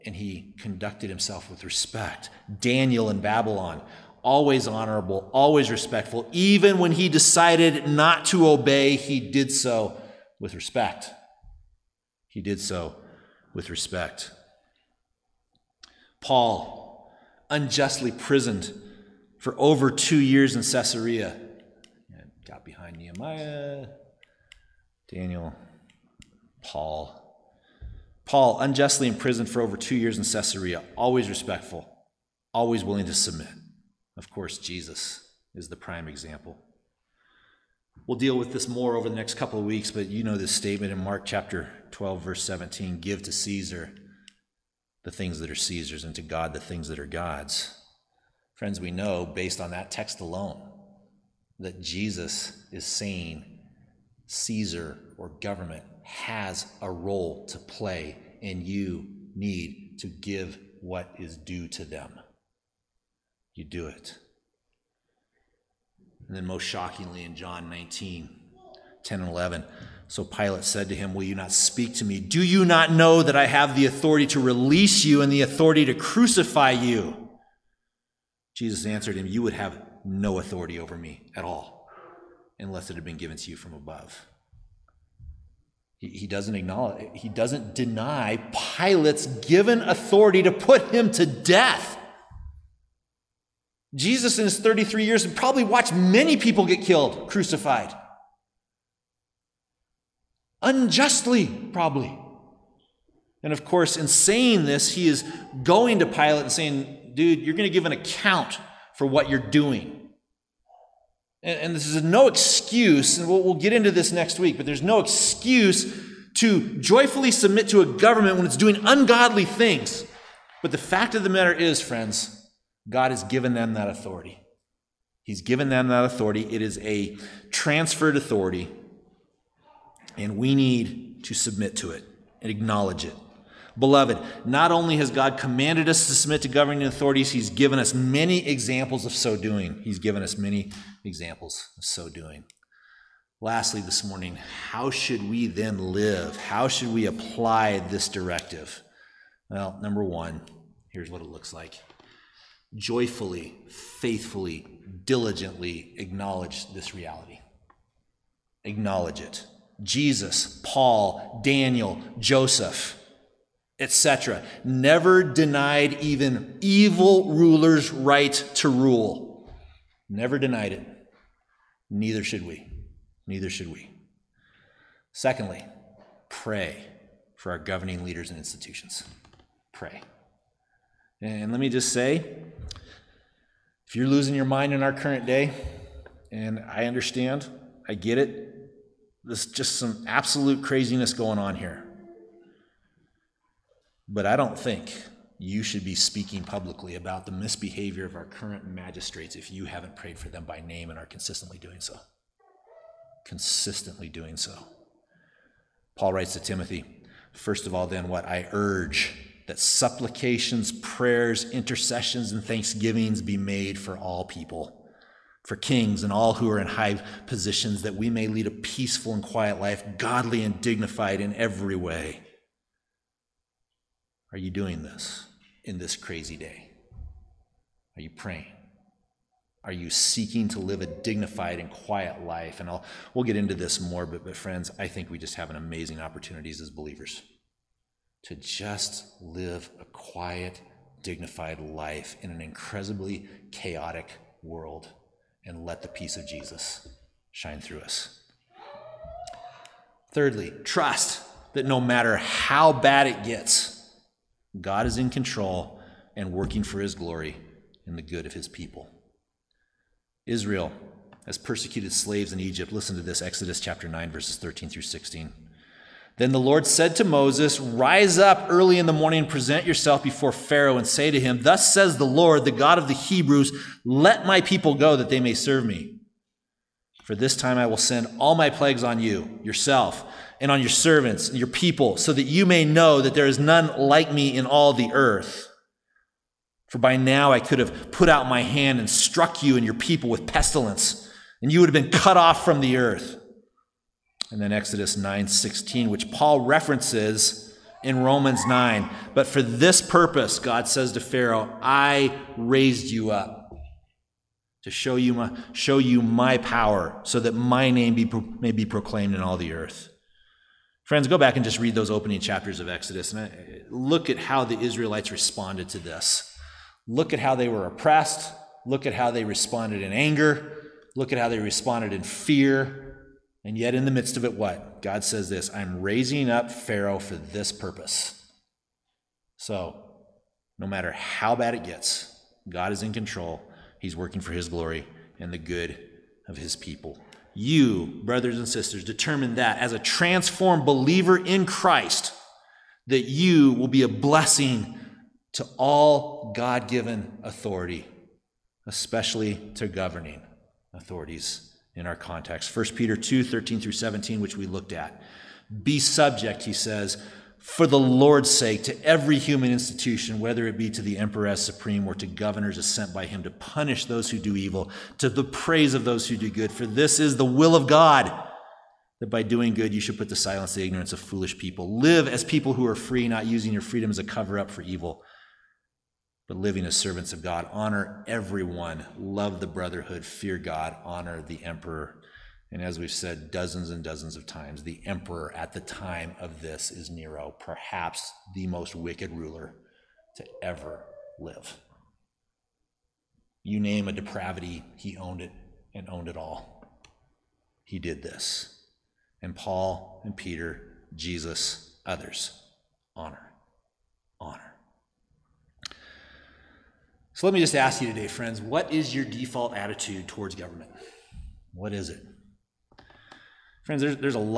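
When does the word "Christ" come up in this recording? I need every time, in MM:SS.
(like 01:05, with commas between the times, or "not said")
05:41.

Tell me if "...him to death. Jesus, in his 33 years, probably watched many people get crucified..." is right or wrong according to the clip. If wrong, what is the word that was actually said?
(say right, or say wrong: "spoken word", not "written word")
wrong: "killed", not "crucified".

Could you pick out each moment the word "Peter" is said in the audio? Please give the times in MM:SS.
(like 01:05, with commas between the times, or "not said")
05:52, 06:40.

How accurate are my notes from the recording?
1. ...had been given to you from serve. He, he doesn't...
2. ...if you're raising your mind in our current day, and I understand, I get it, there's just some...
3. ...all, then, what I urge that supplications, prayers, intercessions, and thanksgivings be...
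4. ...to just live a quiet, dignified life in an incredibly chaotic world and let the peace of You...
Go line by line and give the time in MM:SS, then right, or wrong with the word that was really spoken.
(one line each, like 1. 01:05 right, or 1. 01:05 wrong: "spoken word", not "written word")
1. 01:22 wrong: "above", not "serve"
2. 03:03 wrong: "losing", not "raising"
3. 03:27 right
4. 03:58 wrong: "Jesus", not "You".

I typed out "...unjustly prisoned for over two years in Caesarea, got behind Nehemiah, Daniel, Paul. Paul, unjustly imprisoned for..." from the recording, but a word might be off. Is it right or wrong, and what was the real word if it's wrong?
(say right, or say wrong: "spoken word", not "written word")
right.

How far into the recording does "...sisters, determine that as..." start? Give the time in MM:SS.
05:38.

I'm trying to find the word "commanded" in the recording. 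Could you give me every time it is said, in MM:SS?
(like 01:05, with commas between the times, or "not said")
02:15.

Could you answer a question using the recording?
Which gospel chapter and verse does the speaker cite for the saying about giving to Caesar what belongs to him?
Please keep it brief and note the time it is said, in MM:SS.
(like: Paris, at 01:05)
Mark 12:17, at 00:41.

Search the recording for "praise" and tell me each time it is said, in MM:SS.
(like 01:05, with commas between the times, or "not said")
06:05.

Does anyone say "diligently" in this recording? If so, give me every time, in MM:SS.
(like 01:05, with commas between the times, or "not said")
02:35.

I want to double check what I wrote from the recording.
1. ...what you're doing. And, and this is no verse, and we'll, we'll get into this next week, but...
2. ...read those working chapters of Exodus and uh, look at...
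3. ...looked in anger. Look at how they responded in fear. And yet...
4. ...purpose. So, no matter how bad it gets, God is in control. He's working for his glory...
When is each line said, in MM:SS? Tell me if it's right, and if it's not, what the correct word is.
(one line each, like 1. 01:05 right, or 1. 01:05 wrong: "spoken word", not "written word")
1. 01:49 wrong: "excuse", not "verse"
2. 05:11 wrong: "opening", not "working"
3. 05:19 wrong: "responded", not "looked"
4. 05:27 right.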